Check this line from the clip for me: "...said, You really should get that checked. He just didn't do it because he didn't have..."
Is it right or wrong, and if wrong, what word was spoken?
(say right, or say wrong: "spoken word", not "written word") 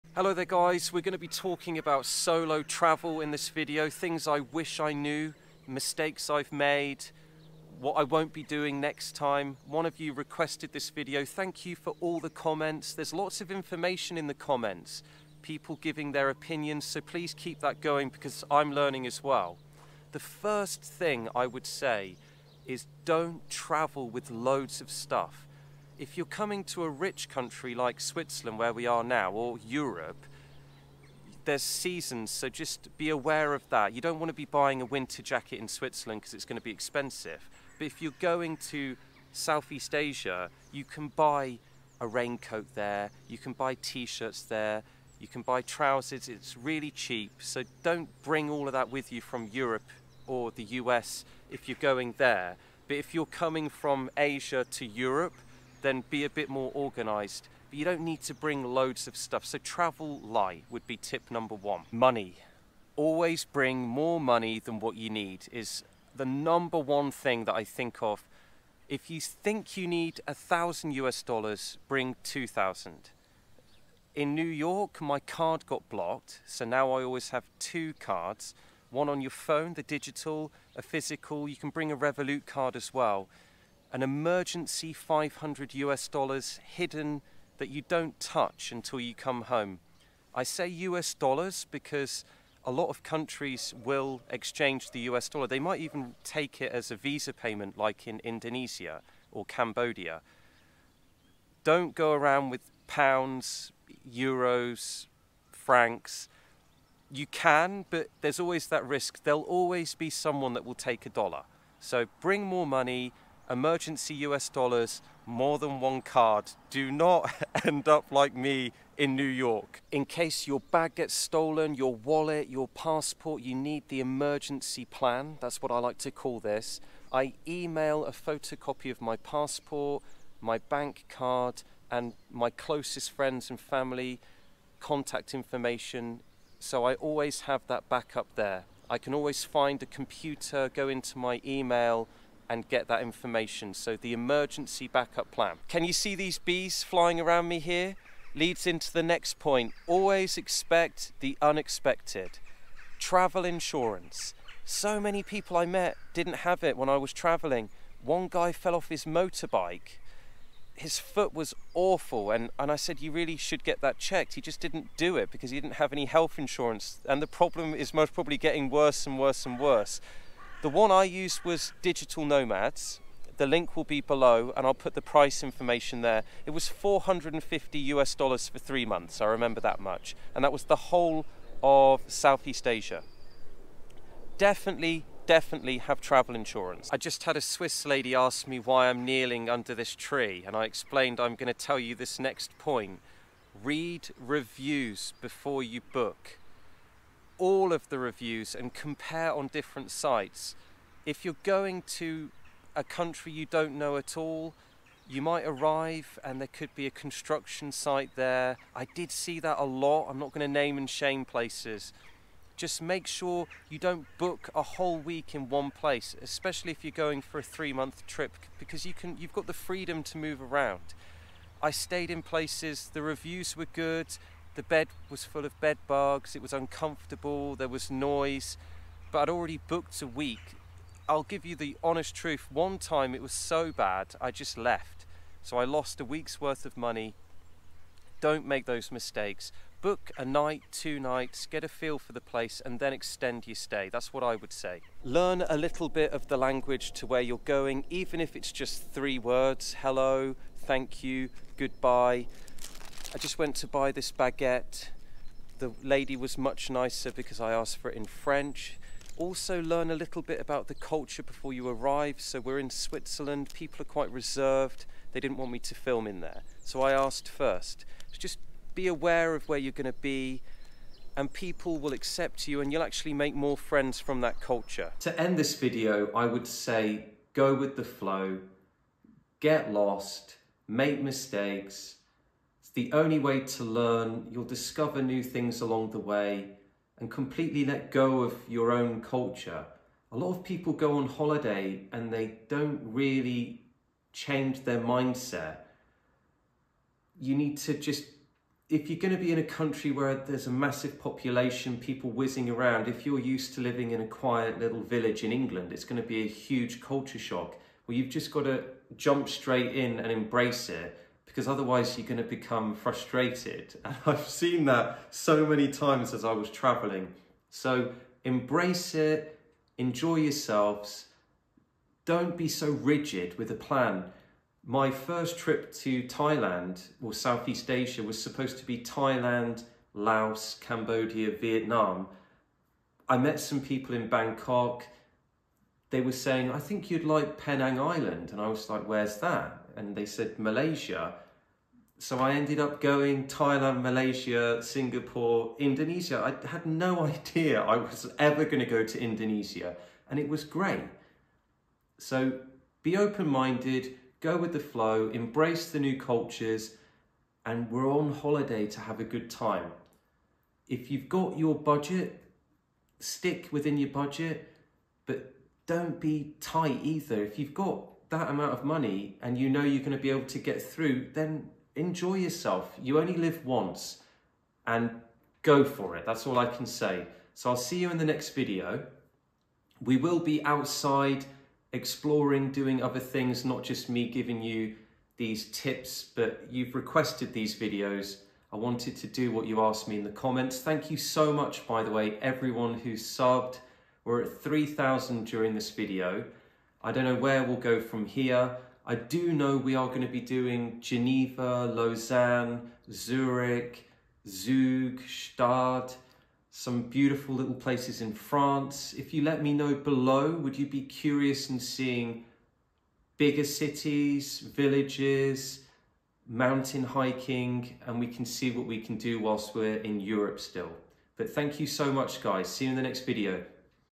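right.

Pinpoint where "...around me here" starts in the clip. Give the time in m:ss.
2:27.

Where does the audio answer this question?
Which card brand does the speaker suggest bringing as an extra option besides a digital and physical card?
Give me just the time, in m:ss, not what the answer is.
1:21.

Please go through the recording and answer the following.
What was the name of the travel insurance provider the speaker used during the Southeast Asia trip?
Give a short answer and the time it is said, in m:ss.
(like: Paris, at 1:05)
Digital Nomads, at 2:51.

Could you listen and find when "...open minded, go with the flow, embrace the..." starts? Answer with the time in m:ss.
5:52.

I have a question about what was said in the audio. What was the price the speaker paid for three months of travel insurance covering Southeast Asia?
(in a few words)
450 US dollars.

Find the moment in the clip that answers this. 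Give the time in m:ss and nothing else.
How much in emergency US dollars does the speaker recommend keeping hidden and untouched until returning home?
1:24.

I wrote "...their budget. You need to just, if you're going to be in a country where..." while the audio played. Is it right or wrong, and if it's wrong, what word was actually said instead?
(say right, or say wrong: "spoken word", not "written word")
wrong: "mindset", not "budget".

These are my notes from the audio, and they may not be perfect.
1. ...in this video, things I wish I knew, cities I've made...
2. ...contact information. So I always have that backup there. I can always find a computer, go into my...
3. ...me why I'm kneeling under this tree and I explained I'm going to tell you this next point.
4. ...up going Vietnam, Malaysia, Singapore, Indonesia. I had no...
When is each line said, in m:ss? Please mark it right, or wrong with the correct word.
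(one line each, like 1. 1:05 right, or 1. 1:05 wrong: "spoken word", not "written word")
1. 0:03 wrong: "mistakes", not "cities"
2. 2:14 right
3. 3:08 right
4. 5:42 wrong: "Thailand", not "Vietnam".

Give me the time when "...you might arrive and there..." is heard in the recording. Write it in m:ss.
3:25.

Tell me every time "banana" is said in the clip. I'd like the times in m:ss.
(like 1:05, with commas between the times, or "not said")
not said.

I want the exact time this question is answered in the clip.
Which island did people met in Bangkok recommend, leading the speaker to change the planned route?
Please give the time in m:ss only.
5:37.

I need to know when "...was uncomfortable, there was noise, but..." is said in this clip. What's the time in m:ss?
3:46.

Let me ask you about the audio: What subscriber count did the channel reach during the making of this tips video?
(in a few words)
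3,000.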